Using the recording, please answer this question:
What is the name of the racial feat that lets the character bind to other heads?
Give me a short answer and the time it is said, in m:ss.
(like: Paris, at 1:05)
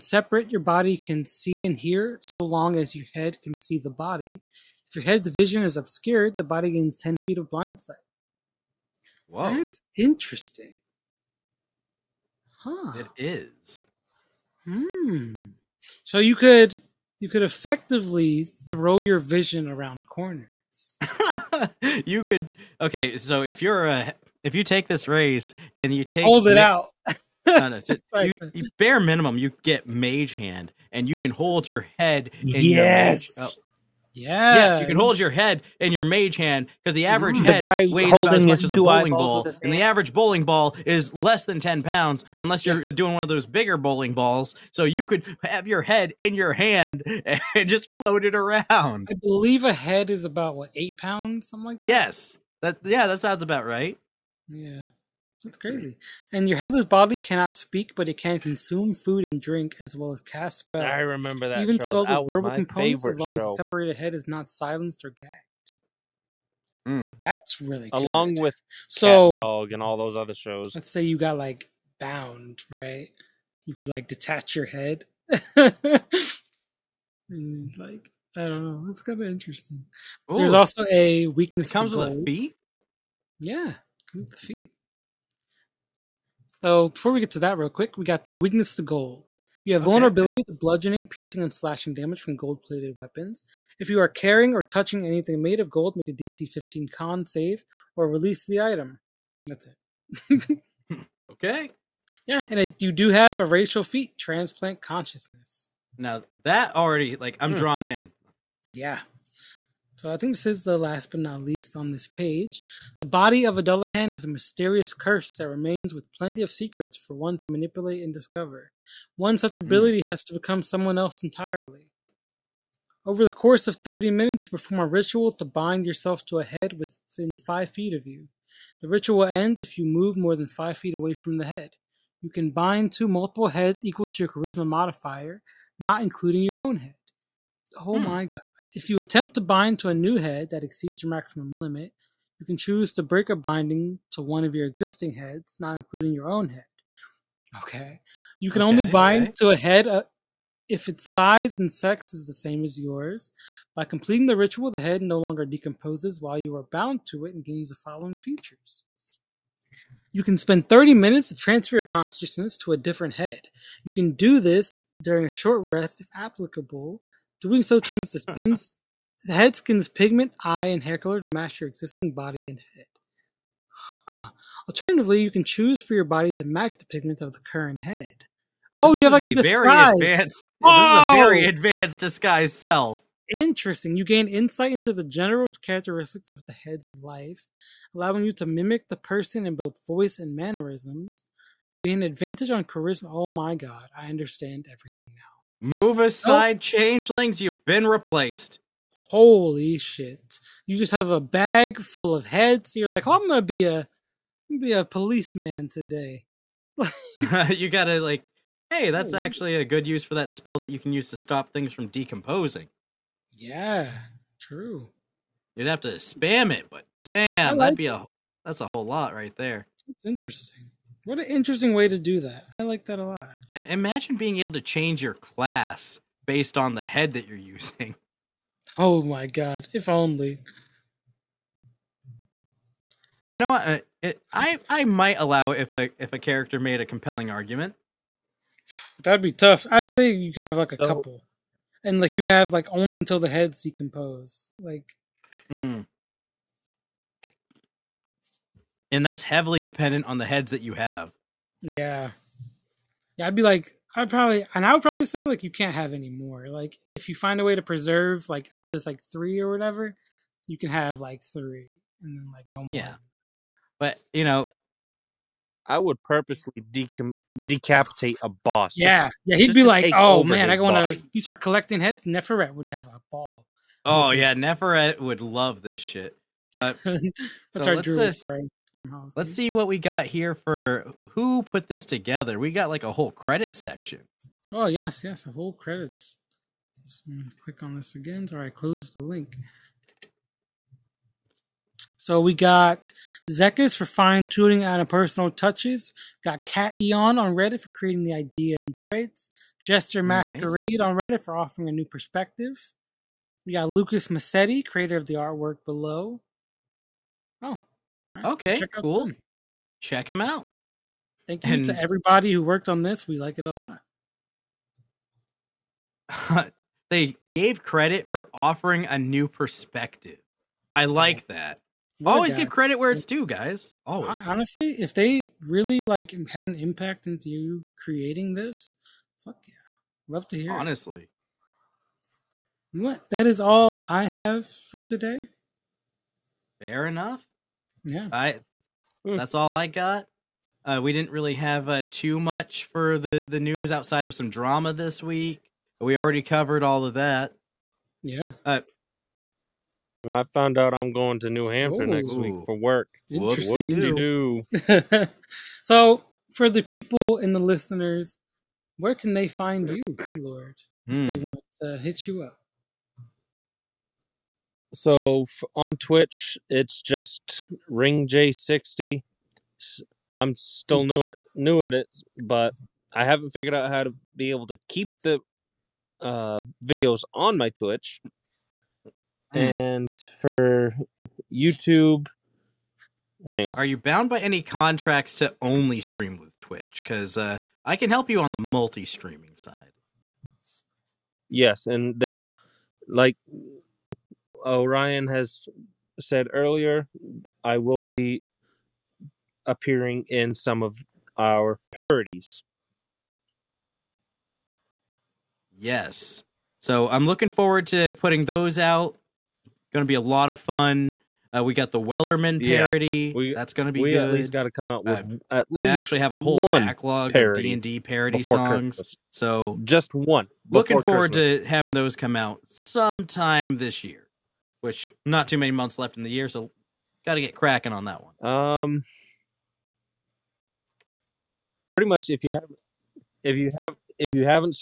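Transplant Consciousness, at 1:44.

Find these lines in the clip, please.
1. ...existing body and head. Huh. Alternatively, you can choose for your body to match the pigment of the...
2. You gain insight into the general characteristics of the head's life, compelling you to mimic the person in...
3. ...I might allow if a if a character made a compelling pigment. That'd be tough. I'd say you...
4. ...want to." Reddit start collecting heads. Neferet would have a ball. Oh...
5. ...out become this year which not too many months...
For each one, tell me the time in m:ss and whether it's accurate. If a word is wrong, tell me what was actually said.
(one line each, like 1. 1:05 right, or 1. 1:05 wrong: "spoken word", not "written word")
1. 2:51 right
2. 3:03 wrong: "allowing", not "compelling"
3. 3:54 wrong: "argument", not "pigment"
4. 4:30 wrong: "You", not "Reddit"
5. 7:02 wrong: "sometime", not "become".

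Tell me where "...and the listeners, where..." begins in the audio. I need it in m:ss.
5:57.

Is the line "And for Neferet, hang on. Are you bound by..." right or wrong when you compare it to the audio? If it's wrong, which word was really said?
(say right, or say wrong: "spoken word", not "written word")
wrong: "YouTube", not "Neferet".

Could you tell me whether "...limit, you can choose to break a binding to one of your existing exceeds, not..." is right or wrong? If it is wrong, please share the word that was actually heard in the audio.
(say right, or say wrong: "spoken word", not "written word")
wrong: "heads", not "exceeds".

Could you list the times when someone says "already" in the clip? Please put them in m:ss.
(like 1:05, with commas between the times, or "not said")
1:46, 5:45.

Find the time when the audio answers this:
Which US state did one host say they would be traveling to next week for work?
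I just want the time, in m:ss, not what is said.
5:51.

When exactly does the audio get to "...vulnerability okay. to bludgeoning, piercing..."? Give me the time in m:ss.
1:29.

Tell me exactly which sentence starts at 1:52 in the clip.
The body of Dullahan is a mysterious curse that remains with plenty of secrets for one to manipulate and discover.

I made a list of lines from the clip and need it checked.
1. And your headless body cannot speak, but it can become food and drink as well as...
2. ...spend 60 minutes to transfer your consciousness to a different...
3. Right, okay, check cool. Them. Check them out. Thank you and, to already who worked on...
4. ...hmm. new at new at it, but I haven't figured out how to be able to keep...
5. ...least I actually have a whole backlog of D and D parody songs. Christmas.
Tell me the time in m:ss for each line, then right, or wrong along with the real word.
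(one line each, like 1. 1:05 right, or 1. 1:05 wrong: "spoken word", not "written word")
1. 0:56 wrong: "consume", not "become"
2. 2:40 wrong: "30", not "60"
3. 5:08 wrong: "everybody", not "already"
4. 6:10 right
5. 6:55 right.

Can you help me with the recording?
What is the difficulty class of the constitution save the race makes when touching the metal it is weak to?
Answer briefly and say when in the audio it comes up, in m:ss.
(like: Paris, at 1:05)
15, at 1:36.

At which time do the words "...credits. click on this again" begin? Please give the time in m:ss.
4:45.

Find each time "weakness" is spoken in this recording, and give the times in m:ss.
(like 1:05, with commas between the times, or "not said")
1:21, 1:28.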